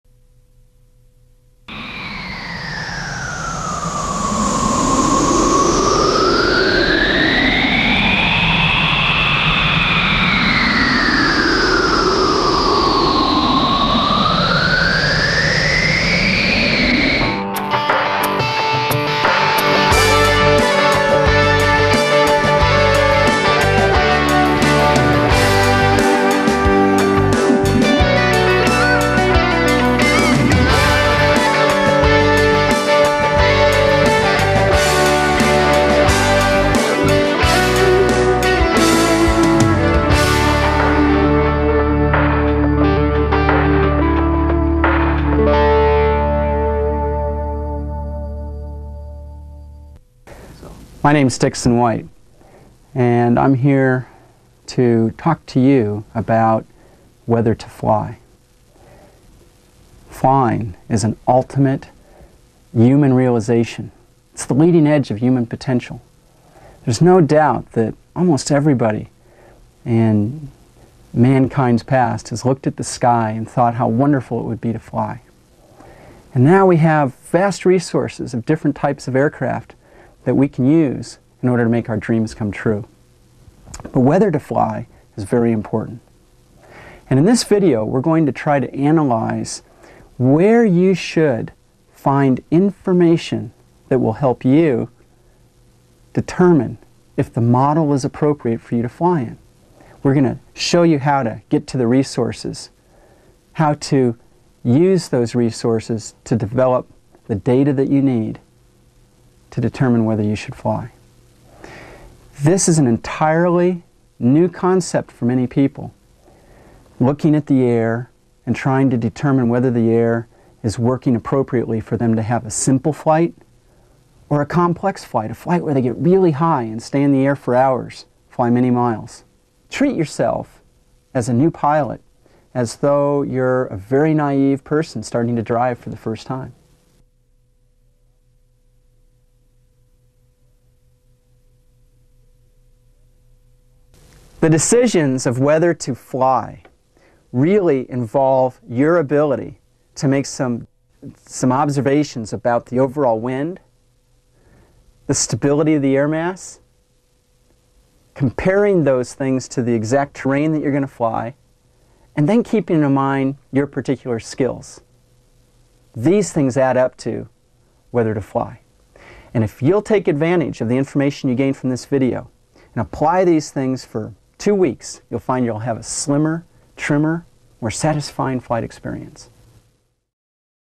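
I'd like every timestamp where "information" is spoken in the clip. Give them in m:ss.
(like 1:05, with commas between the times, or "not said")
1:32, 2:50.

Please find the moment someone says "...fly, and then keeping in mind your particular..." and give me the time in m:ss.
2:40.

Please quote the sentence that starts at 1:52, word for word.
This is an entirely new concept for many people.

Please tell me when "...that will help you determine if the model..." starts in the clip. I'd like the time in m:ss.
1:33.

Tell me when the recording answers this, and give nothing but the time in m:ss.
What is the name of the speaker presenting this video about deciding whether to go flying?
0:51.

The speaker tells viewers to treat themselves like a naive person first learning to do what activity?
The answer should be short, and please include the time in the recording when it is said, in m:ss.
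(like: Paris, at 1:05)
drive, at 2:15.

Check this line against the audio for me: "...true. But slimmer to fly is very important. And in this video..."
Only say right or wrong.
wrong.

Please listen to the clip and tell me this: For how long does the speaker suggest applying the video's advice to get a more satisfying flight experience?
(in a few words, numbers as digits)
2 weeks.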